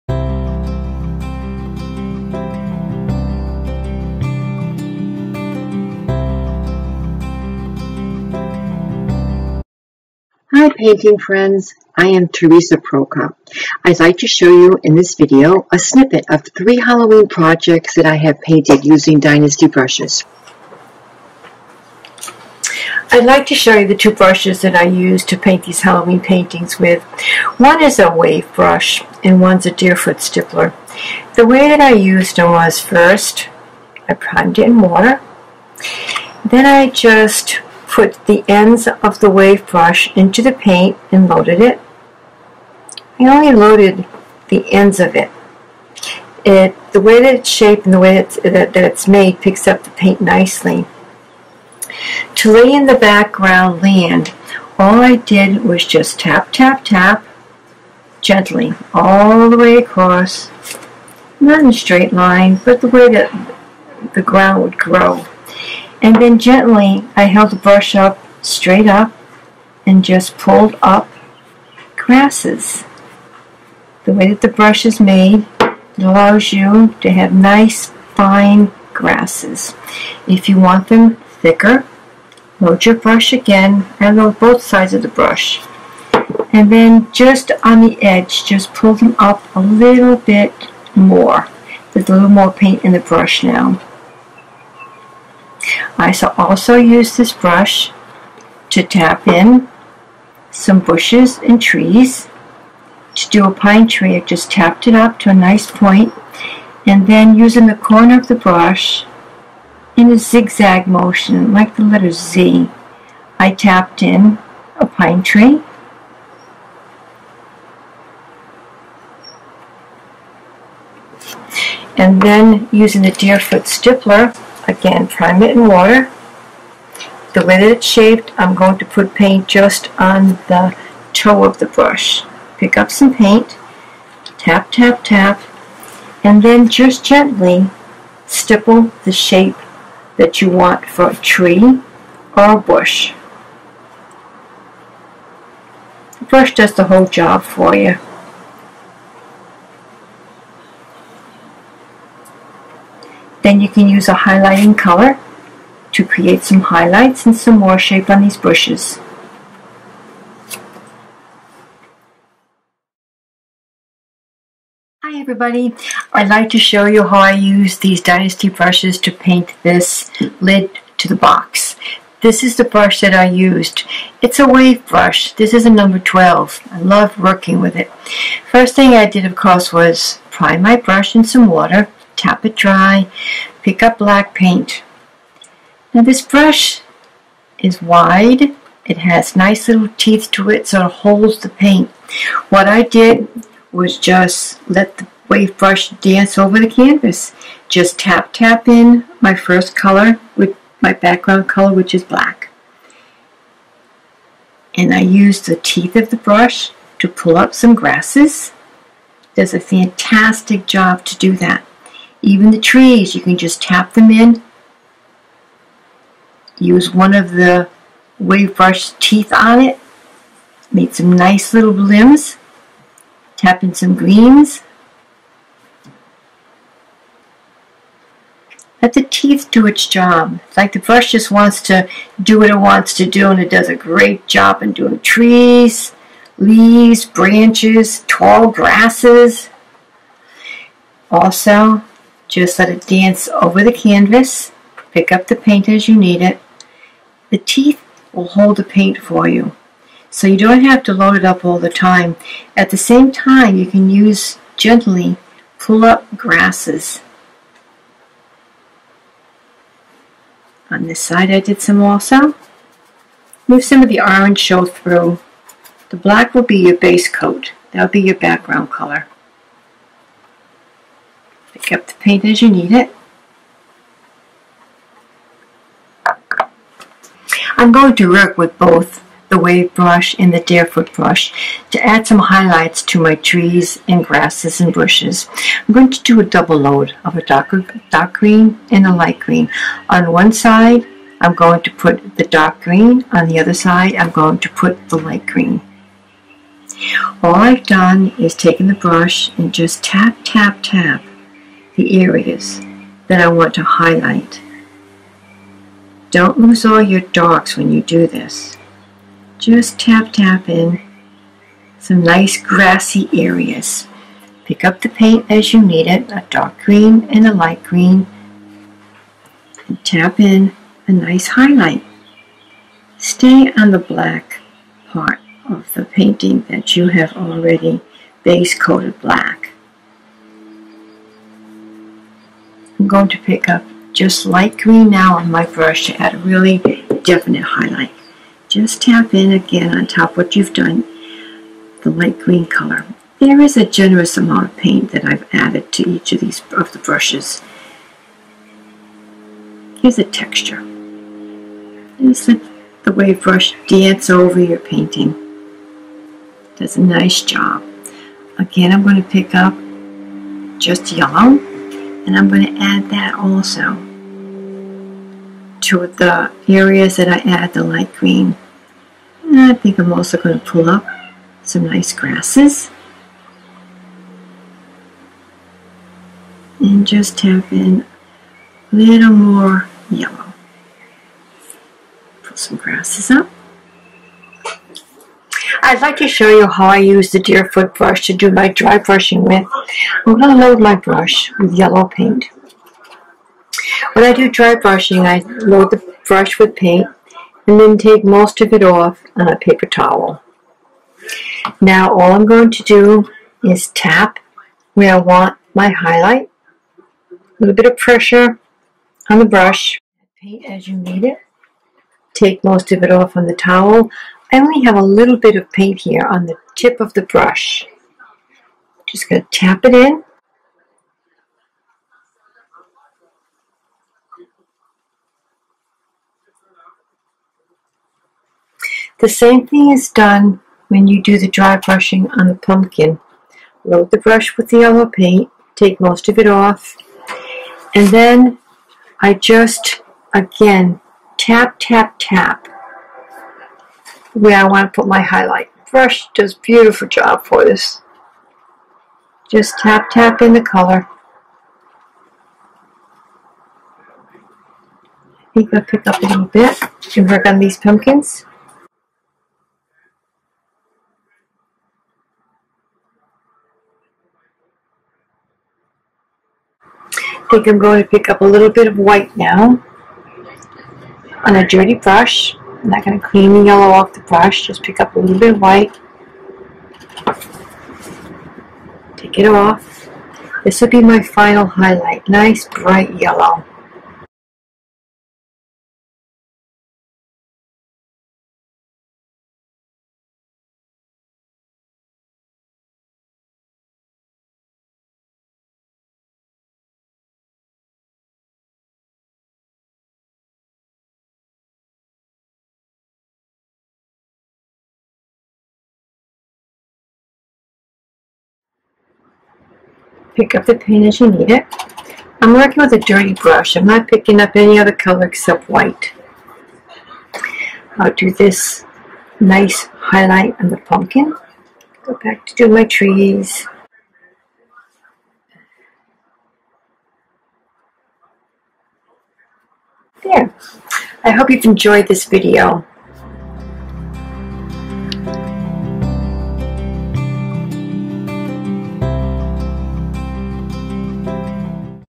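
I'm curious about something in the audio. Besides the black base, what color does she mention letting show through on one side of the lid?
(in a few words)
Orange.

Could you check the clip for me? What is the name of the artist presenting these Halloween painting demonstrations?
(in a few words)
Theresa Prokop.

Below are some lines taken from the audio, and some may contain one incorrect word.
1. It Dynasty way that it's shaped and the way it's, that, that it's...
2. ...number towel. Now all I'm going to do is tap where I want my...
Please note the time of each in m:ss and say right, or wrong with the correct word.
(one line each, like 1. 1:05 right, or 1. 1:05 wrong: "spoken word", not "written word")
1. 0:46 wrong: "The", not "Dynasty"
2. 6:39 wrong: "paper", not "number".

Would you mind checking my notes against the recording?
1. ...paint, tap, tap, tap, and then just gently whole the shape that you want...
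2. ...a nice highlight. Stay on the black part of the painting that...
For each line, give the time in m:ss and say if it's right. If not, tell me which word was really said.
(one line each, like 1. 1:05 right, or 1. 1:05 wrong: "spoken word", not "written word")
1. 2:13 wrong: "stipple", not "whole"
2. 5:20 right.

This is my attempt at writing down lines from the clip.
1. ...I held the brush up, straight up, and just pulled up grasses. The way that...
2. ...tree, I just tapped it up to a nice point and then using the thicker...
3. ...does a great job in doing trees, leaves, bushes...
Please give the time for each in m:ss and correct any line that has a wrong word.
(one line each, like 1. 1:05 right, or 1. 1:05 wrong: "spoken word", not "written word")
1. 1:07 right
2. 1:43 wrong: "corner", not "thicker"
3. 3:53 wrong: "branches", not "bushes".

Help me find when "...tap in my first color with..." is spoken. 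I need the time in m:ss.
3:18.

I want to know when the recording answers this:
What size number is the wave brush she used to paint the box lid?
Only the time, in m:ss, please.
2:55.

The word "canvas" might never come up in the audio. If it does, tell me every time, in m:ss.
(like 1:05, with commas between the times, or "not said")
3:16, 4:03.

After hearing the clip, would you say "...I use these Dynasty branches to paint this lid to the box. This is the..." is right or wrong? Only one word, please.
wrong.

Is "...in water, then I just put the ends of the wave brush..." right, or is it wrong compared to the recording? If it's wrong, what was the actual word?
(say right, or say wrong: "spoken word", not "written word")
right.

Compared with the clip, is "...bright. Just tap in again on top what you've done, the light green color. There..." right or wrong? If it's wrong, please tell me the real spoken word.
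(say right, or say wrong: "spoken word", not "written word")
wrong: "highlight", not "bright".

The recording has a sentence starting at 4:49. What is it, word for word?
On one side I'm going to put the dark green, on the other side I'm going to put the light green.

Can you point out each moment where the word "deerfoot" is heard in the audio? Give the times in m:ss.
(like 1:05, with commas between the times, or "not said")
0:29, 2:03, 4:40, 6:27.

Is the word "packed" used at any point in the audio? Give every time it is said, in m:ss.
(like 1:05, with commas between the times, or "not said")
not said.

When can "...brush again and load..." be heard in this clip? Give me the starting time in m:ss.
1:22.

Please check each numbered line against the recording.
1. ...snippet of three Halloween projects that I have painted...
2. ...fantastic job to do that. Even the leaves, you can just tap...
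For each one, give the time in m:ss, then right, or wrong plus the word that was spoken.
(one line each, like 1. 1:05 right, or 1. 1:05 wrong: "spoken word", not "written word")
1. 0:15 right
2. 3:29 wrong: "trees", not "leaves".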